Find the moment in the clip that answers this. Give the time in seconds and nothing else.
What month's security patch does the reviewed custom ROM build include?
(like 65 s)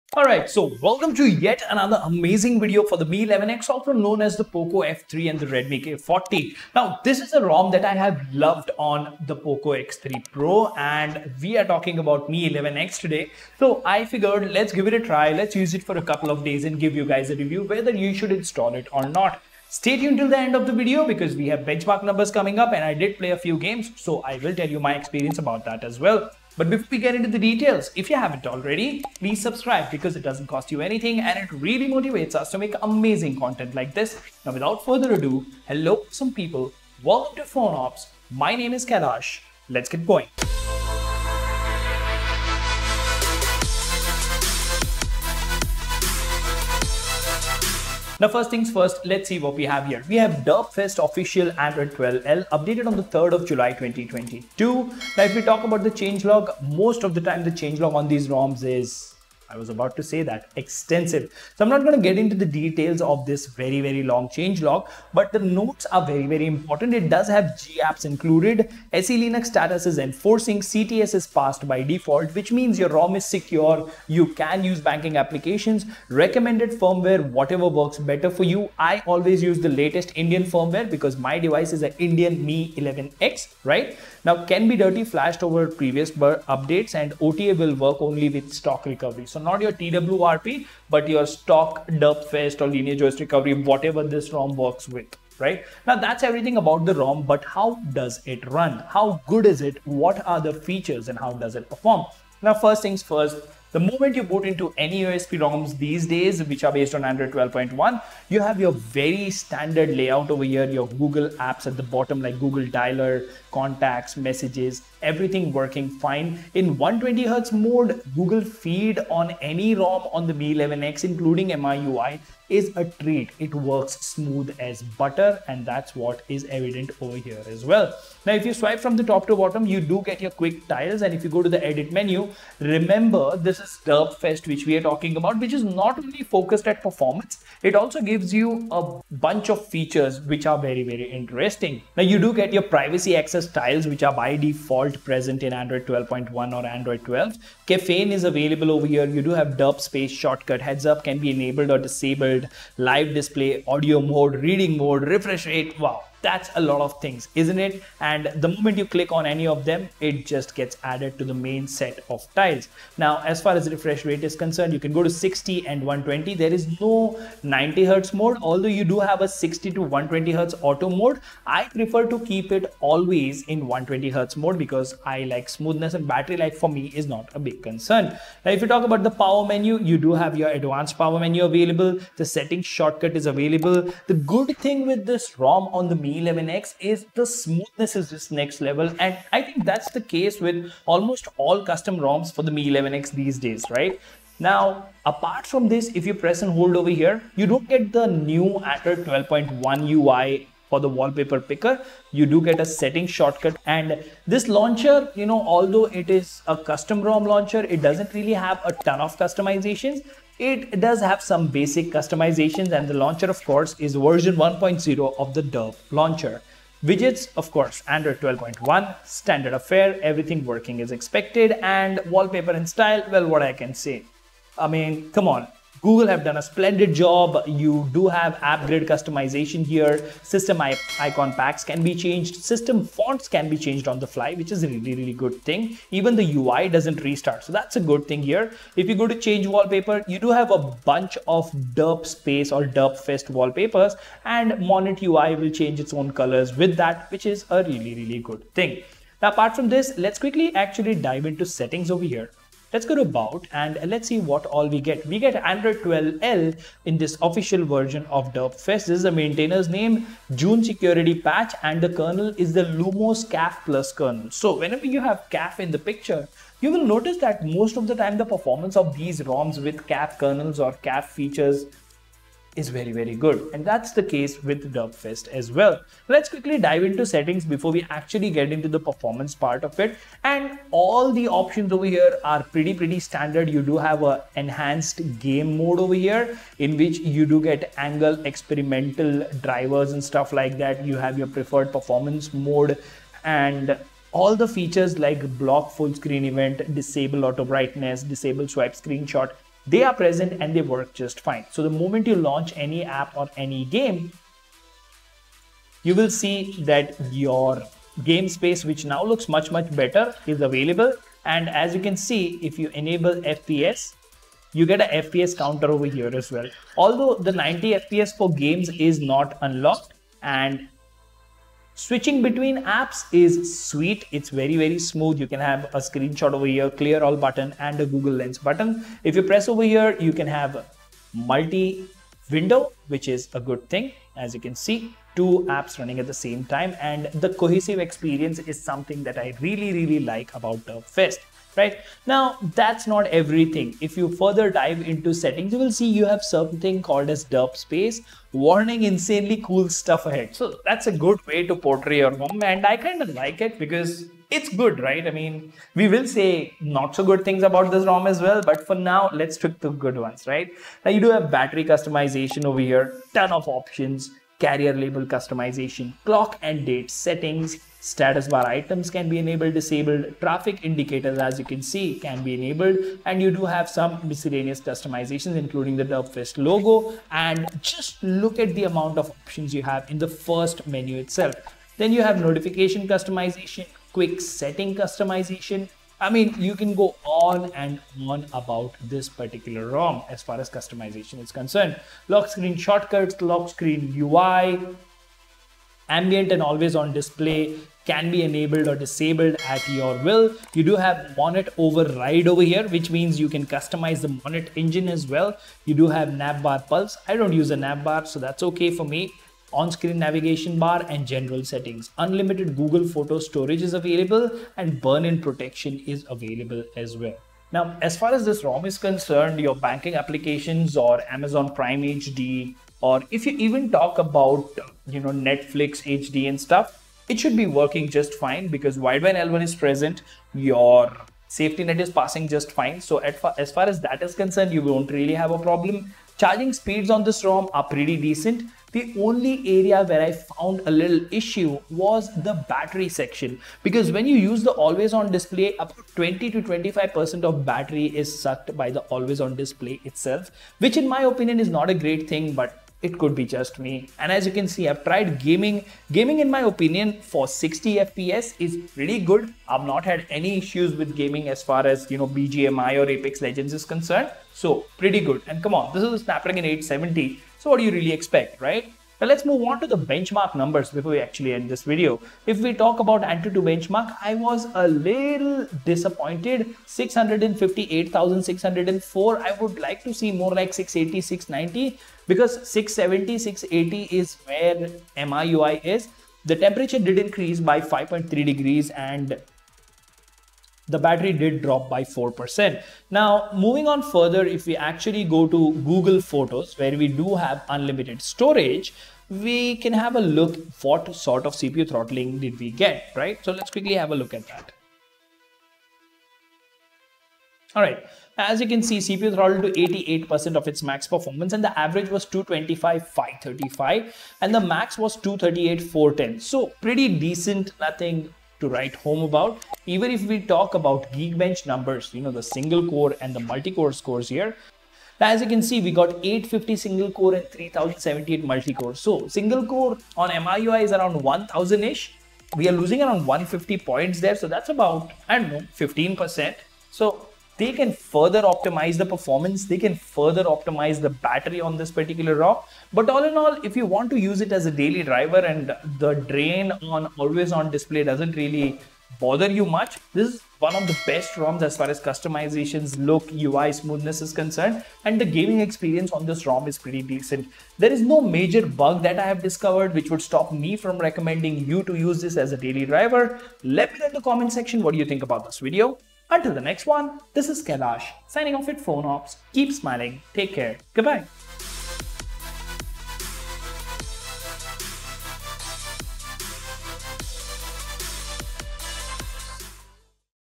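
260 s.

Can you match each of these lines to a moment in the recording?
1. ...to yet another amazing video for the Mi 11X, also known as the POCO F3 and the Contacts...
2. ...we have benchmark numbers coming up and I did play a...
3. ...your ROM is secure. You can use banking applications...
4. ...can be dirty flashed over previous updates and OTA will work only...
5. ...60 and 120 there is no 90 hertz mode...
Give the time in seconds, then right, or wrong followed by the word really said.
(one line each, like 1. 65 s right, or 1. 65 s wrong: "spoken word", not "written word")
1. 1 s wrong: "Redmi", not "Contacts"
2. 21 s right
3. 72 s right
4. 84 s right
5. 165 s right.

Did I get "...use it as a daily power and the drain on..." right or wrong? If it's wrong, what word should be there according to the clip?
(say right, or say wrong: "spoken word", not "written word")
wrong: "driver", not "power".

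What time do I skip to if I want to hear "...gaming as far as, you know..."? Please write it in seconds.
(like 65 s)
460 s.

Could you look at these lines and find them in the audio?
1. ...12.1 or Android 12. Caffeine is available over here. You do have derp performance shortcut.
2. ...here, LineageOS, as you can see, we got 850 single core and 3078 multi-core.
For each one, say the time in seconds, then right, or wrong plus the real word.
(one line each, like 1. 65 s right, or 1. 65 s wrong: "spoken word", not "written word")
1. 145 s wrong: "space", not "performance"
2. 524 s wrong: "Now", not "LineageOS".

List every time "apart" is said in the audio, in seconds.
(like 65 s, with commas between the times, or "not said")
195 s, 249 s.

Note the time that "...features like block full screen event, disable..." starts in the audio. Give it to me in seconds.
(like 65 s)
294 s.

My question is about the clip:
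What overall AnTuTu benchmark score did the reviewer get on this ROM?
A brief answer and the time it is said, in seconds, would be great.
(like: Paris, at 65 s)
658,604, at 476 s.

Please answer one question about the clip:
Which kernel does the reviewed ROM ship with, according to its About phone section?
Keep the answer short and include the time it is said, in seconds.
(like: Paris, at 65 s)
Lumos CAF plus, at 262 s.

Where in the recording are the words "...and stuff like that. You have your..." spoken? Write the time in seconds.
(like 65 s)
289 s.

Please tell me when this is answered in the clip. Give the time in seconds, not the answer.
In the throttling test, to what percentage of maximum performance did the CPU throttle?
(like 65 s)
509 s.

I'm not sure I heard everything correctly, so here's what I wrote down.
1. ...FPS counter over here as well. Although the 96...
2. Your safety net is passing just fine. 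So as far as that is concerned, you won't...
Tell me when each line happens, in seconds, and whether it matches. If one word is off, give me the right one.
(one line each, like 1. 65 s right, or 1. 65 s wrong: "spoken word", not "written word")
1. 315 s wrong: "90", not "96"
2. 430 s right.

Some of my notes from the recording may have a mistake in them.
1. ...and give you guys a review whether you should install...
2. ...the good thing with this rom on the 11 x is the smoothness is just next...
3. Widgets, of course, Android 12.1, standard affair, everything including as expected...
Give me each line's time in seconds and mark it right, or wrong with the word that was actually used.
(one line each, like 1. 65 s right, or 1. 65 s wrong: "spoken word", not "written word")
1. 16 s right
2. 184 s right
3. 216 s wrong: "working", not "including".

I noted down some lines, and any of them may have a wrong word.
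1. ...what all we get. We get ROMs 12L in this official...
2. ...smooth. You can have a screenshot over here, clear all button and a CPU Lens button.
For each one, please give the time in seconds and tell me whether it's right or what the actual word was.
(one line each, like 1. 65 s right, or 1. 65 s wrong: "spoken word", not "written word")
1. 254 s wrong: "Android", not "ROMs"
2. 324 s wrong: "Google", not "CPU".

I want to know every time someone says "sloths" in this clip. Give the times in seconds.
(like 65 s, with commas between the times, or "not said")
not said.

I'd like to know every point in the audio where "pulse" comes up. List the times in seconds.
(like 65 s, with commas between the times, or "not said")
406 s.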